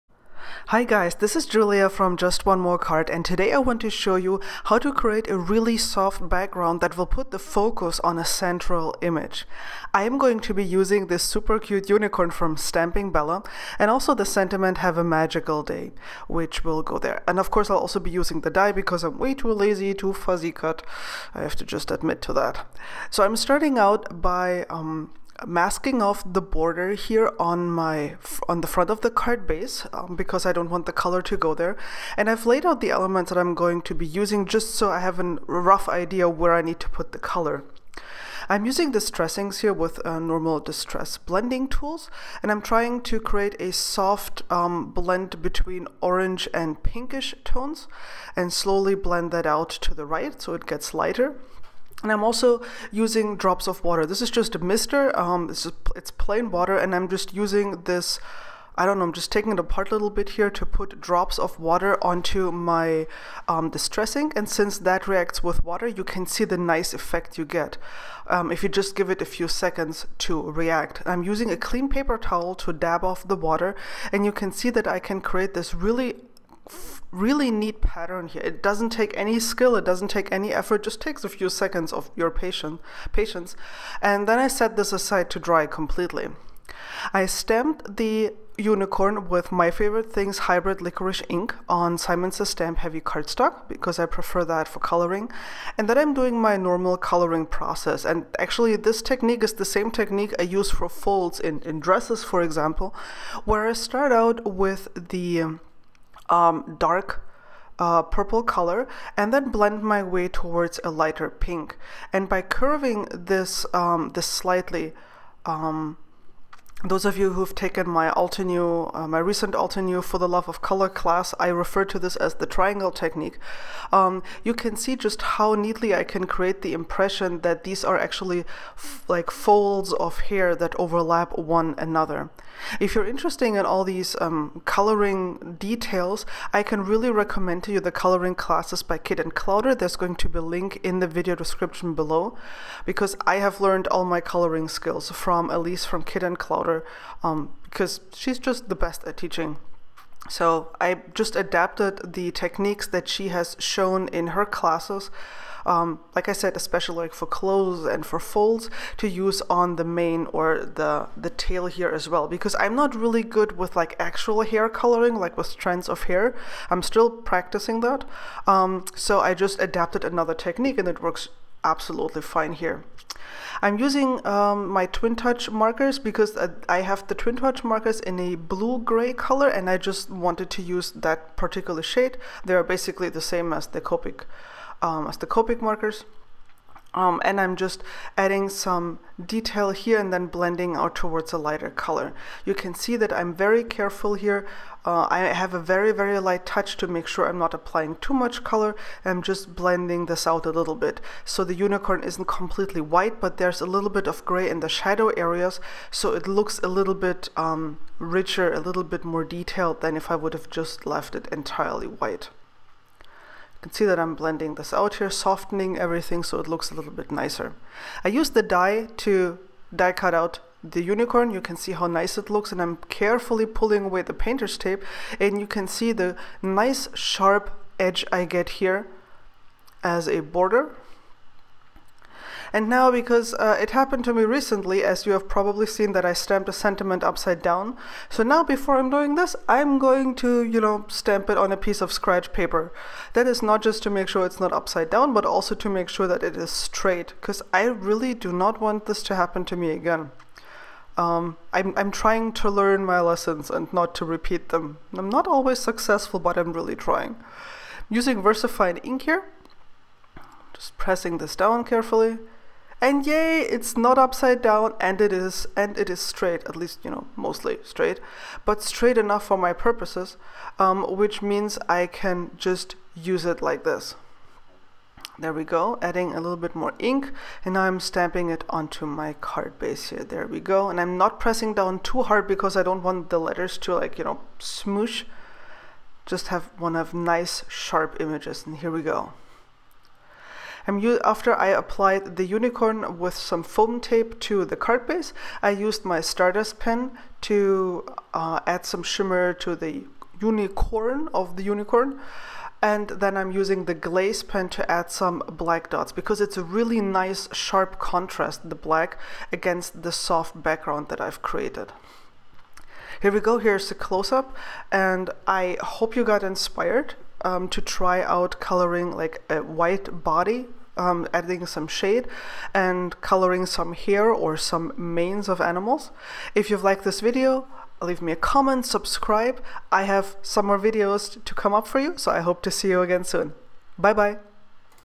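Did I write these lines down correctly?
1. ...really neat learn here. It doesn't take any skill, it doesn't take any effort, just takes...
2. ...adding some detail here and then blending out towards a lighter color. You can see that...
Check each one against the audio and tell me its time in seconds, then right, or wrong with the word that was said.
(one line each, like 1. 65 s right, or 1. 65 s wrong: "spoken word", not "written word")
1. 77 s wrong: "pattern", not "learn"
2. 188 s right.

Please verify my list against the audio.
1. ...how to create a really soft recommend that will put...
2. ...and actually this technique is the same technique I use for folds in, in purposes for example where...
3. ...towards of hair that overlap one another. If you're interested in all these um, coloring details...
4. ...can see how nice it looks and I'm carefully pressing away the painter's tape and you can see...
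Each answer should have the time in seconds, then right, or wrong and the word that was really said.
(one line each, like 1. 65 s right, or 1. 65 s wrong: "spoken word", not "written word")
1. 4 s wrong: "background", not "recommend"
2. 98 s wrong: "dresses", not "purposes"
3. 129 s wrong: "folds", not "towards"
4. 221 s wrong: "pulling", not "pressing".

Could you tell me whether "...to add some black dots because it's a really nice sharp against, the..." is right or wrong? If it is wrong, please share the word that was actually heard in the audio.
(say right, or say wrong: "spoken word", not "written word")
wrong: "contrast", not "against".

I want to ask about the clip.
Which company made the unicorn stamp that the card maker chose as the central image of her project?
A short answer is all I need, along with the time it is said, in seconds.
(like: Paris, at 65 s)
Stamping Bella, at 12 s.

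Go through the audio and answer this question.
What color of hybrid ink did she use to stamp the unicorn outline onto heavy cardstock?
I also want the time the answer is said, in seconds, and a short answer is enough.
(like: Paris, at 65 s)
licorice, at 90 s.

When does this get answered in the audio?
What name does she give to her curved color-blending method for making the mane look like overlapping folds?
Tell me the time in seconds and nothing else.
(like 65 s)
122 s.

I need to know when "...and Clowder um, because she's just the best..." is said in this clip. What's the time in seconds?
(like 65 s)
146 s.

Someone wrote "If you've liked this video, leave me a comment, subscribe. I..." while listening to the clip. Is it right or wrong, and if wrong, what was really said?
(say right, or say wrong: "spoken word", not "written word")
right.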